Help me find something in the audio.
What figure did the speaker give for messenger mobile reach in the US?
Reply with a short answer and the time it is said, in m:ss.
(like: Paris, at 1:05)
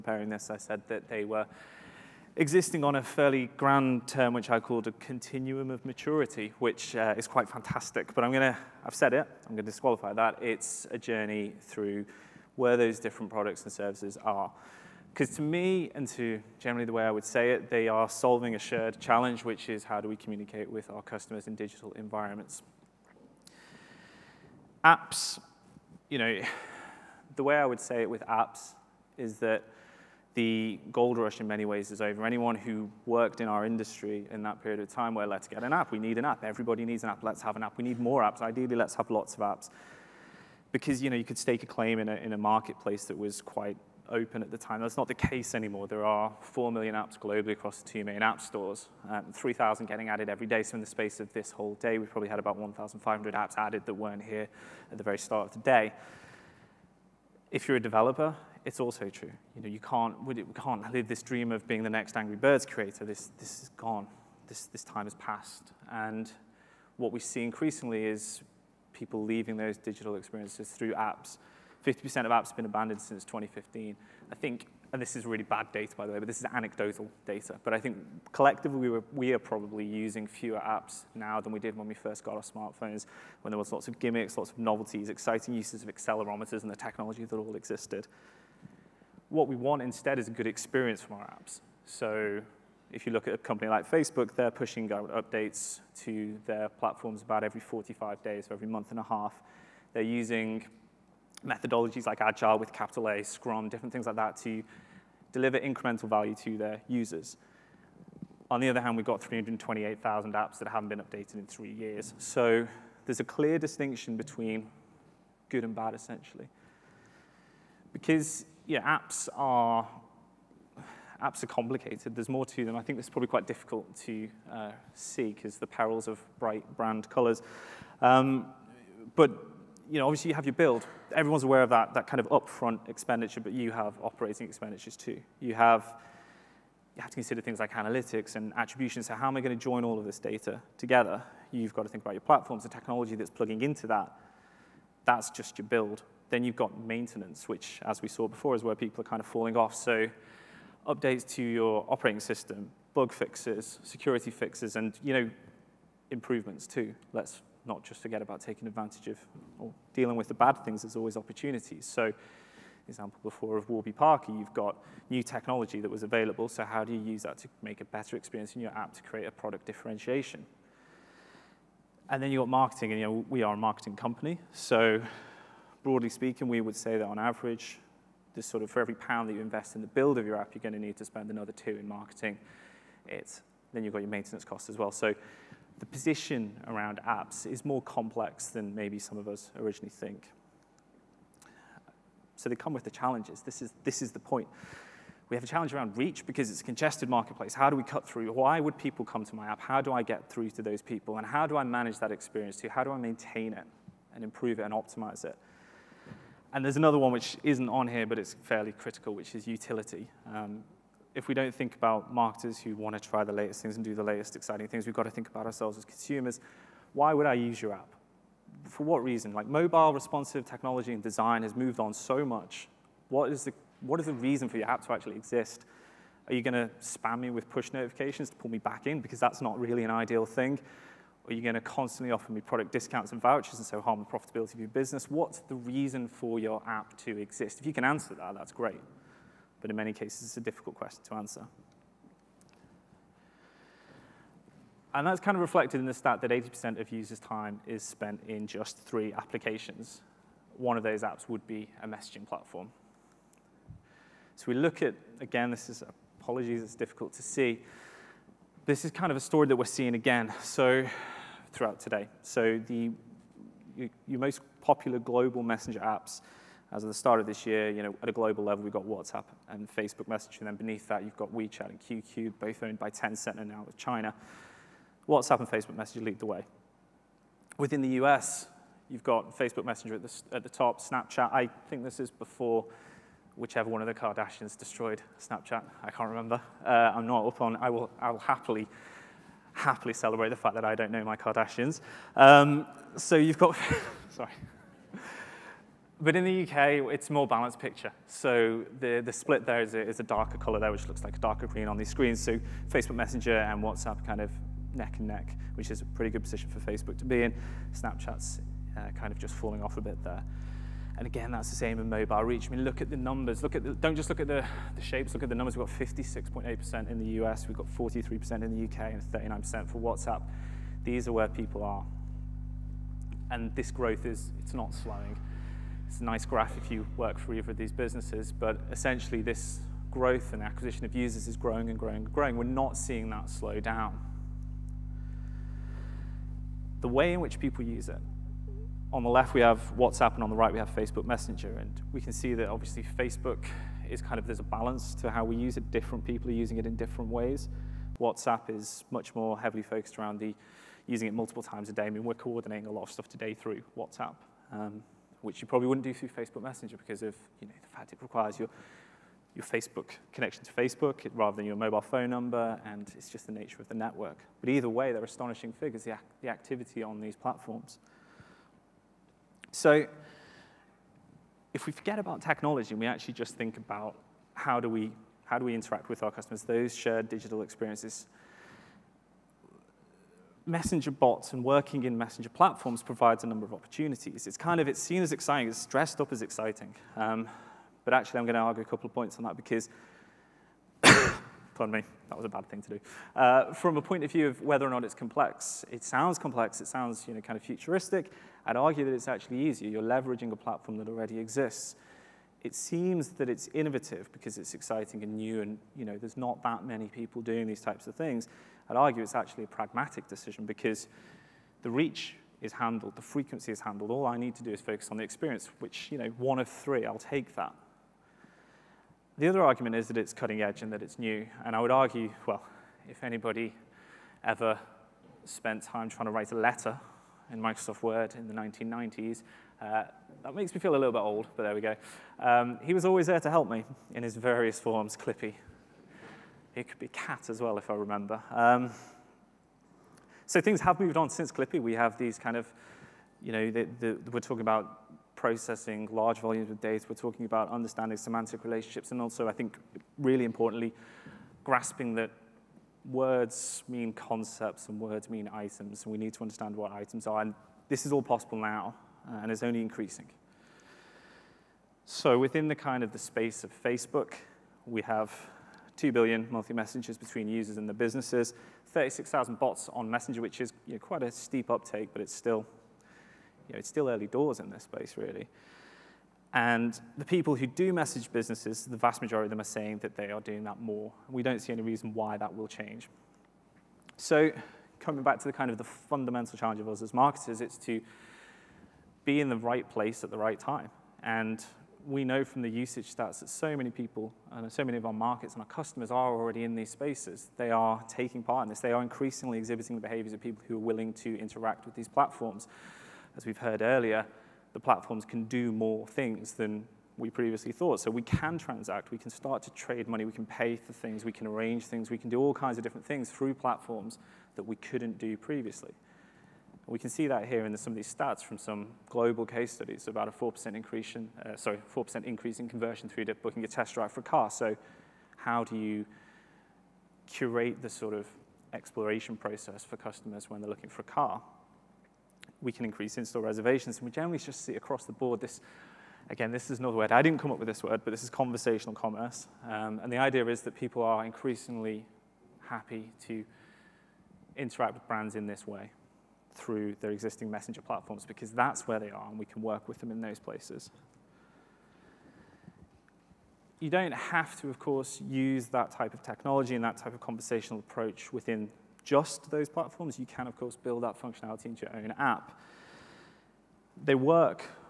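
56.8%, at 5:15.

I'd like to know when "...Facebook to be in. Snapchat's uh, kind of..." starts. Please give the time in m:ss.
5:06.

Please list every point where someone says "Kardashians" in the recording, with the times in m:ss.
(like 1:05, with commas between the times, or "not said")
4:43, 4:51.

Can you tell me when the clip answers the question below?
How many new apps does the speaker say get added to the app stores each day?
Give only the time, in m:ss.
0:49.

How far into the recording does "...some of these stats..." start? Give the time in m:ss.
8:37.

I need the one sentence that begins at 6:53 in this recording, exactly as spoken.
All I need to do is focus on the experience, which, you know, one of three, I'll take that.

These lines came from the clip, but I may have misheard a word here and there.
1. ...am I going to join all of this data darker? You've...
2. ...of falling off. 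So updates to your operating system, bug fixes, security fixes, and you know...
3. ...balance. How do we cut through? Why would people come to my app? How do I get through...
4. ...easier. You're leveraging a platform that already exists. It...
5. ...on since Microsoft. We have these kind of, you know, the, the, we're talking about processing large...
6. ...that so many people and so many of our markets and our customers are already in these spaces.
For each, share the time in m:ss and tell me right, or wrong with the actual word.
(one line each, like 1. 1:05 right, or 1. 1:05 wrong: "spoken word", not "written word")
1. 2:19 wrong: "together", not "darker"
2. 2:29 right
3. 3:17 wrong: "marketplace", not "balance"
4. 6:39 right
5. 7:20 wrong: "Clippy", not "Microsoft"
6. 8:13 right.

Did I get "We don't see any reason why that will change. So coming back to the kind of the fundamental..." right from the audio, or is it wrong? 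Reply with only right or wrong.
right.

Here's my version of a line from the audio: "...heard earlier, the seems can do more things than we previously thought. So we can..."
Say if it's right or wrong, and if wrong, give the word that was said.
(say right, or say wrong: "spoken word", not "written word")
wrong: "platforms", not "seems".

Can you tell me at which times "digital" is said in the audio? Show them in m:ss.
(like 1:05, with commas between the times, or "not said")
0:21, 1:09, 6:17.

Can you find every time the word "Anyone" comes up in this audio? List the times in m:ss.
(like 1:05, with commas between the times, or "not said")
0:32.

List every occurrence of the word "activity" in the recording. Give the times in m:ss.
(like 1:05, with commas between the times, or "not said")
6:06.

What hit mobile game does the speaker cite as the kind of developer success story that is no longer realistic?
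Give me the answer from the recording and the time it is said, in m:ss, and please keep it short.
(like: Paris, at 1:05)
Angry Birds, at 1:02.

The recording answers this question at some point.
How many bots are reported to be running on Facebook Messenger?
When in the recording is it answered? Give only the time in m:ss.
7:48.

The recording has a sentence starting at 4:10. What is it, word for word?
One of those apps would be a messaging platform.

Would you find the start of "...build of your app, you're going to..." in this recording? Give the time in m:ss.
2:59.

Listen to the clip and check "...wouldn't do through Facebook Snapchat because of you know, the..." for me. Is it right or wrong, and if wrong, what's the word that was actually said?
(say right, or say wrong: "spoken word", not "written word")
wrong: "Messenger", not "Snapchat".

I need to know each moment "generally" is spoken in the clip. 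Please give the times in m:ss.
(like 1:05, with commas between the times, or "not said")
0:16, 8:53.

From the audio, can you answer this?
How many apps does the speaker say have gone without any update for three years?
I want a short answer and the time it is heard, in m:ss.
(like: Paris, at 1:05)
328,000, at 1:49.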